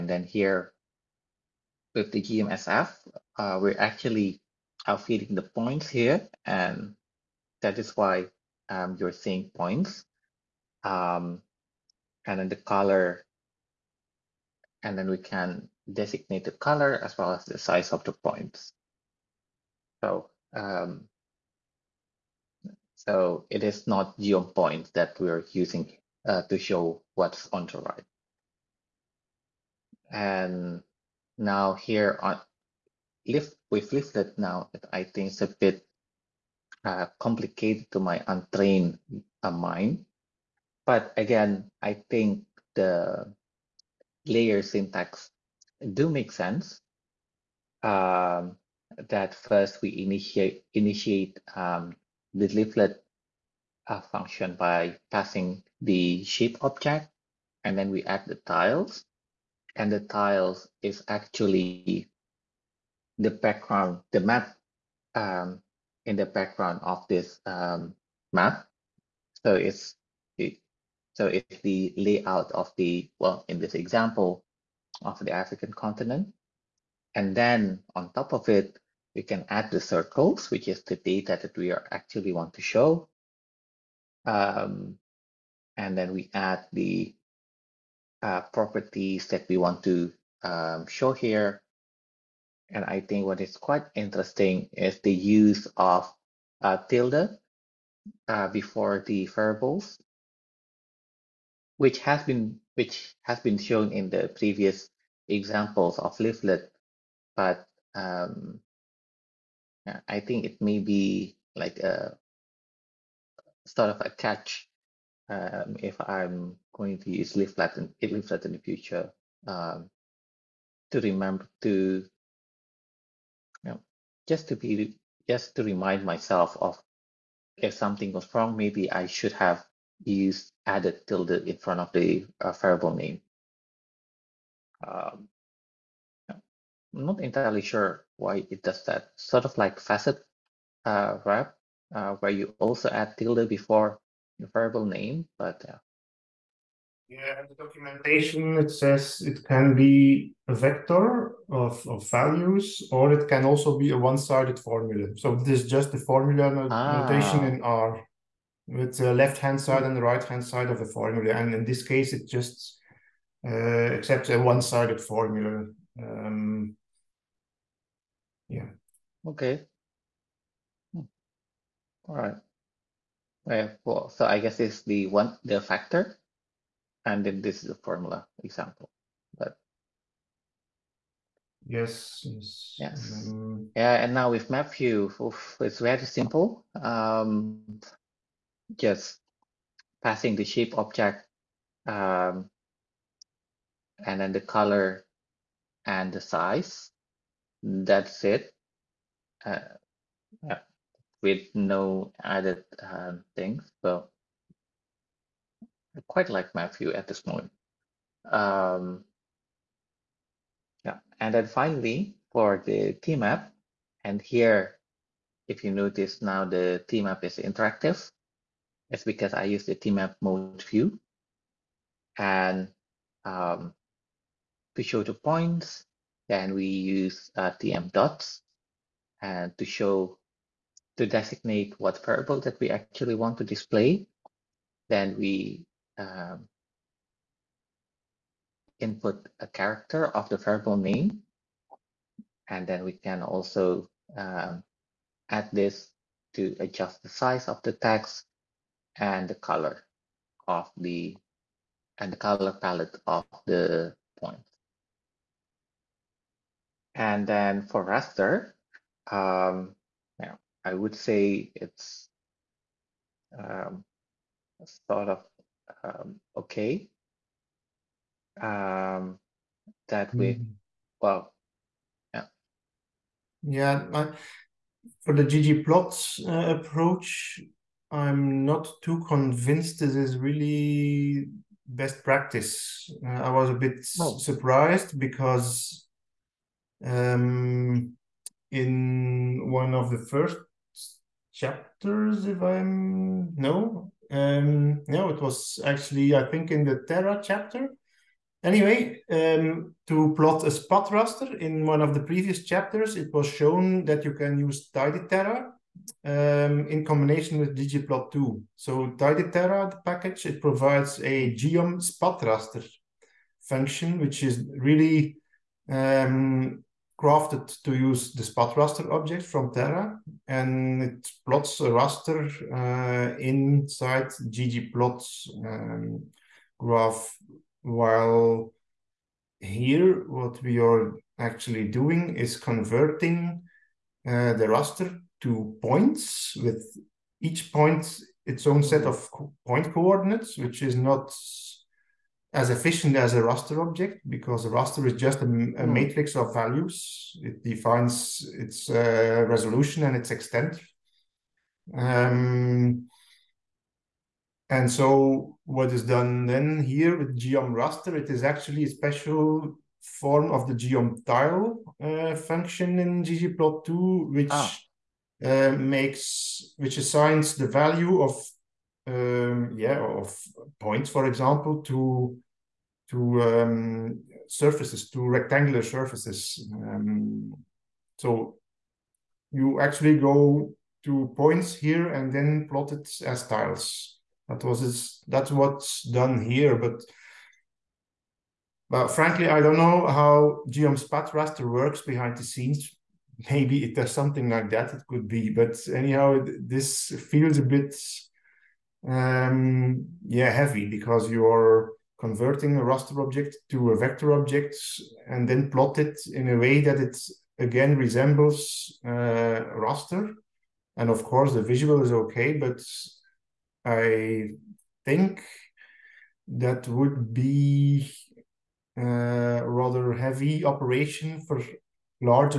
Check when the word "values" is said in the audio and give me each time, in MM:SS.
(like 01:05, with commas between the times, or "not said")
02:32, 05:46, 06:07.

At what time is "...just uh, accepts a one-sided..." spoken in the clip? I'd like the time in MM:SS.
02:42.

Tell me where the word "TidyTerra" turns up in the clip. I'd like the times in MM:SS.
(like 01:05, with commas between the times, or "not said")
05:04, 05:08.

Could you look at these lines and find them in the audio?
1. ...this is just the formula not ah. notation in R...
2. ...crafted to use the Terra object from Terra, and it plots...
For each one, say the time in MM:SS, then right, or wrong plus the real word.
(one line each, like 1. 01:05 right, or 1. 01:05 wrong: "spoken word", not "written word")
1. 02:35 right
2. 05:17 wrong: "SpatRaster", not "Terra".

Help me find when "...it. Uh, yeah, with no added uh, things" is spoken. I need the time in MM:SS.
03:18.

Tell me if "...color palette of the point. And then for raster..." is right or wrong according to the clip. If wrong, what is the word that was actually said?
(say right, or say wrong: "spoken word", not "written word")
right.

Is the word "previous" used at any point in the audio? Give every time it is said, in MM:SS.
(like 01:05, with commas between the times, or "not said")
01:44, 05:02.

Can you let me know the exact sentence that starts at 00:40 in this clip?
But again, I think the layer syntax do make sense.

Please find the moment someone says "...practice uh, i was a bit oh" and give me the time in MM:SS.
04:42.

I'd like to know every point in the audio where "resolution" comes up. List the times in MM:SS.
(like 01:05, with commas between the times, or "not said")
05:49.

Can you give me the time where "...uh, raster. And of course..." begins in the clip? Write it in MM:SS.
06:48.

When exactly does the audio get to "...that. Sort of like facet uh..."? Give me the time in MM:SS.
02:18.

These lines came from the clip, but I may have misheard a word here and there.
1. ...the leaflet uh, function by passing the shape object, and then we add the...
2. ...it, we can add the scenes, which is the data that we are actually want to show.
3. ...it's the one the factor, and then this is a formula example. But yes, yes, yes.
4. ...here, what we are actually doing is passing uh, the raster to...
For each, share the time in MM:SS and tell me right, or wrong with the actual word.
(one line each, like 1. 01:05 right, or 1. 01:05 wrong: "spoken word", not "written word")
1. 00:52 right
2. 01:18 wrong: "circles", not "scenes"
3. 02:54 right
4. 05:29 wrong: "converting", not "passing".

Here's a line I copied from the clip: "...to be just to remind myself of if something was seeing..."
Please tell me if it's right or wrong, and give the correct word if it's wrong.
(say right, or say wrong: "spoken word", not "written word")
wrong: "wrong", not "seeing".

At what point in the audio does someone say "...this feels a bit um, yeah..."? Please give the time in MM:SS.
06:36.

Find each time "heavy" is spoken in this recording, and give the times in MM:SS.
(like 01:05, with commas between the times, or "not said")
06:40, 06:59.